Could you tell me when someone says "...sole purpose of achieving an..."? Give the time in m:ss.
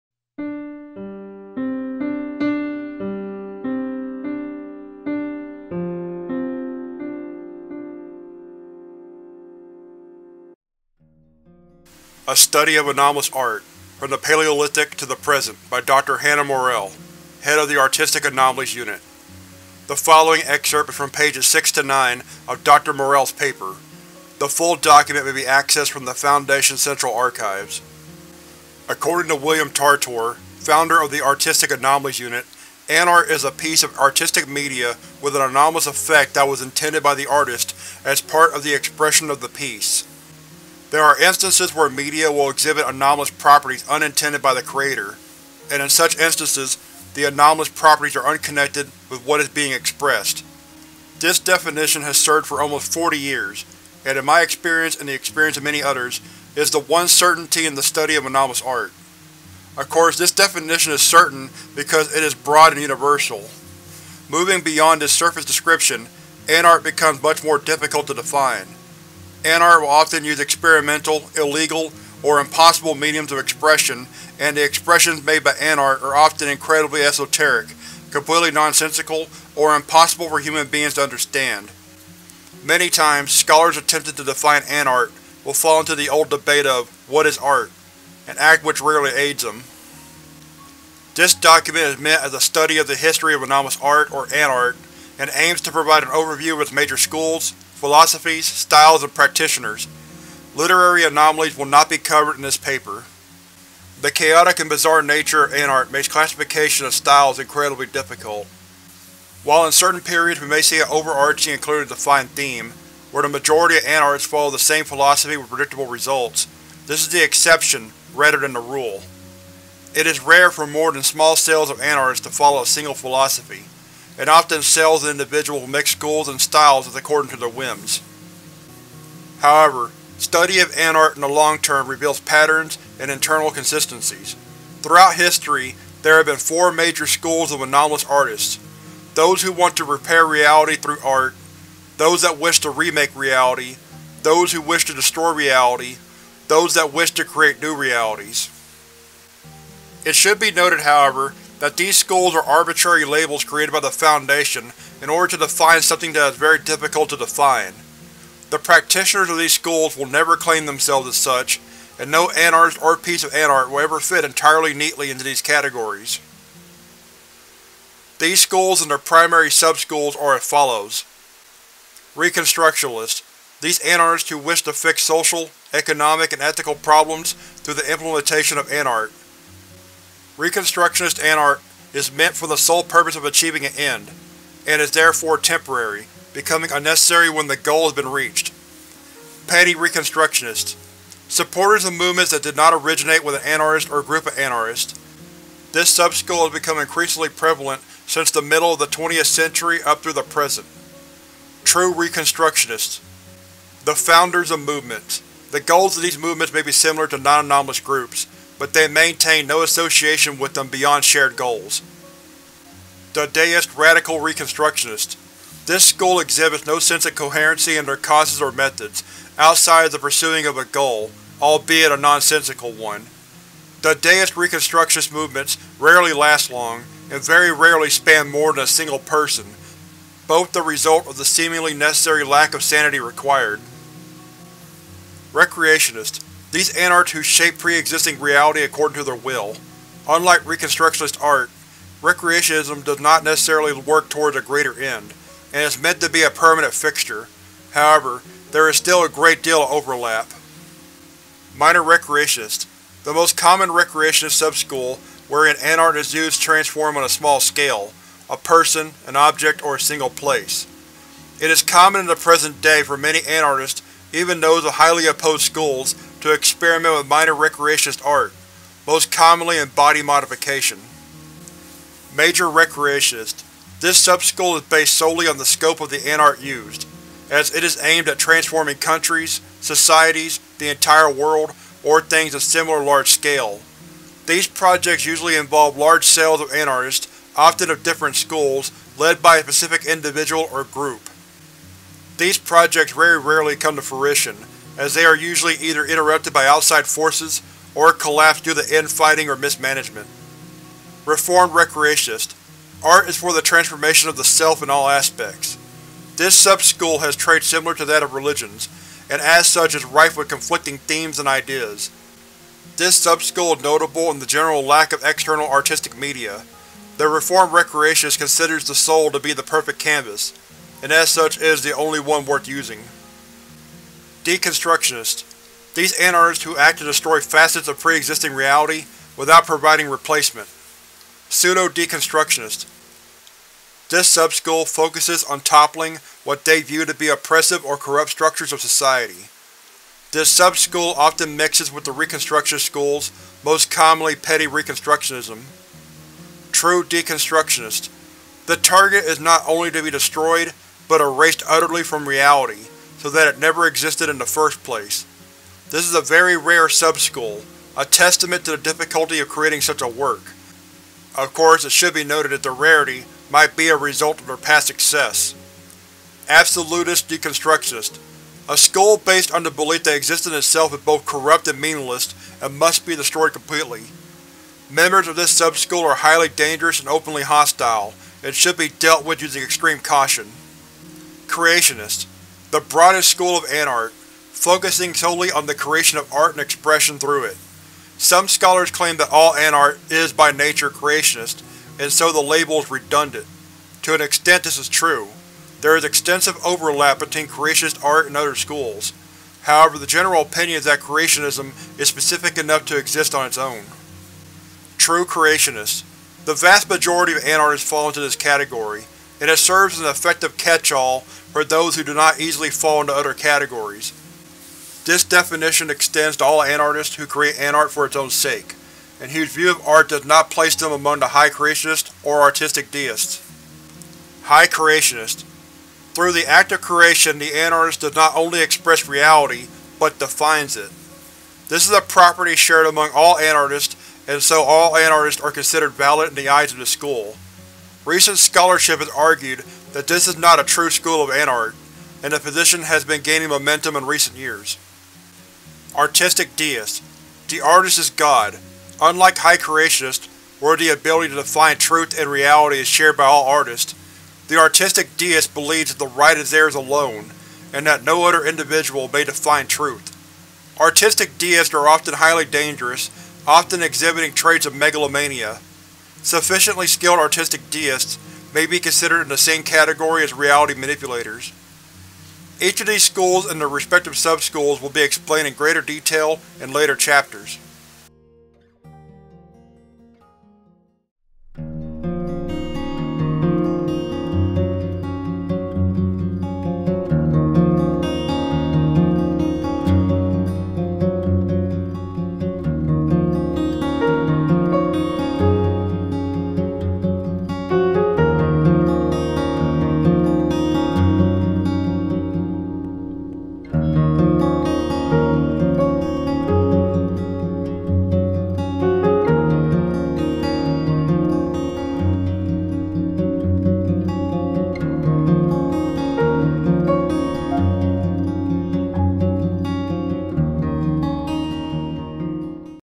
3:02.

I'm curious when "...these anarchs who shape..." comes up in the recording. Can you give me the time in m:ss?
3:56.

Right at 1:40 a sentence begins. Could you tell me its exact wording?
Literary anomalies will not be covered in this paper.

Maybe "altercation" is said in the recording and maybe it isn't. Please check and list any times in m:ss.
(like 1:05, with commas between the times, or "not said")
not said.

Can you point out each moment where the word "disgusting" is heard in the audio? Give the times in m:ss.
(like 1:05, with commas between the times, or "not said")
not said.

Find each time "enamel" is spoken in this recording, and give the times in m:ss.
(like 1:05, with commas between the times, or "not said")
not said.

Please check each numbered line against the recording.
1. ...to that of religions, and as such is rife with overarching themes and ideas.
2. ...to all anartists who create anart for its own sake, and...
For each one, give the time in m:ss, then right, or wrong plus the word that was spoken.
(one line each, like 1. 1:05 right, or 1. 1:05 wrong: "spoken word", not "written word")
1. 5:07 wrong: "conflicting", not "overarching"
2. 6:56 right.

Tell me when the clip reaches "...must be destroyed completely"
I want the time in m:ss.
6:12.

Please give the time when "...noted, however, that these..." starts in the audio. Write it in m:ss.
2:30.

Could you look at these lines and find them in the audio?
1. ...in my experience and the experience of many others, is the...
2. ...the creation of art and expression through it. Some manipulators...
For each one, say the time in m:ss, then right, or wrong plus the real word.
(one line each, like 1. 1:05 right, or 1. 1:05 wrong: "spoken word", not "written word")
1. 0:54 right
2. 6:25 wrong: "scholars", not "manipulators".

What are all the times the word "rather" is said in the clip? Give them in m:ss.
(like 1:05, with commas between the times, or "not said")
1:58.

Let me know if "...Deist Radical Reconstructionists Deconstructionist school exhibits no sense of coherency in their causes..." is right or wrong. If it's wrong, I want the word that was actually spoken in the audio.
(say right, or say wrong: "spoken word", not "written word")
wrong: "This", not "Deconstructionist".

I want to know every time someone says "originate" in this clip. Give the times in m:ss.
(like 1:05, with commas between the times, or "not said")
3:12.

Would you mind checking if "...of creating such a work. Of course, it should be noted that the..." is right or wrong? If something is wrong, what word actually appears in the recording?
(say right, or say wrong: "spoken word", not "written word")
right.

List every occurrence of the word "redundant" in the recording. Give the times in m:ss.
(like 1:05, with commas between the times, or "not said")
6:32.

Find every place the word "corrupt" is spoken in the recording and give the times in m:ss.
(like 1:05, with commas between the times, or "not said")
5:37, 6:11.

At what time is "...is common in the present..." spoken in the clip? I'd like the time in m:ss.
4:21.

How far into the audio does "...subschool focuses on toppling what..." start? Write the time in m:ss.
5:34.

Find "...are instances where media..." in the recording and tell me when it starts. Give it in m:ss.
0:41.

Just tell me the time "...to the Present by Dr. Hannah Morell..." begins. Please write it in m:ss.
0:14.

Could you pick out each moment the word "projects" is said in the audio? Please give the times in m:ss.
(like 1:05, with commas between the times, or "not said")
4:44, 4:52.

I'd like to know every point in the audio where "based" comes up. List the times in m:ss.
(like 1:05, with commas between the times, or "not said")
4:34, 6:08.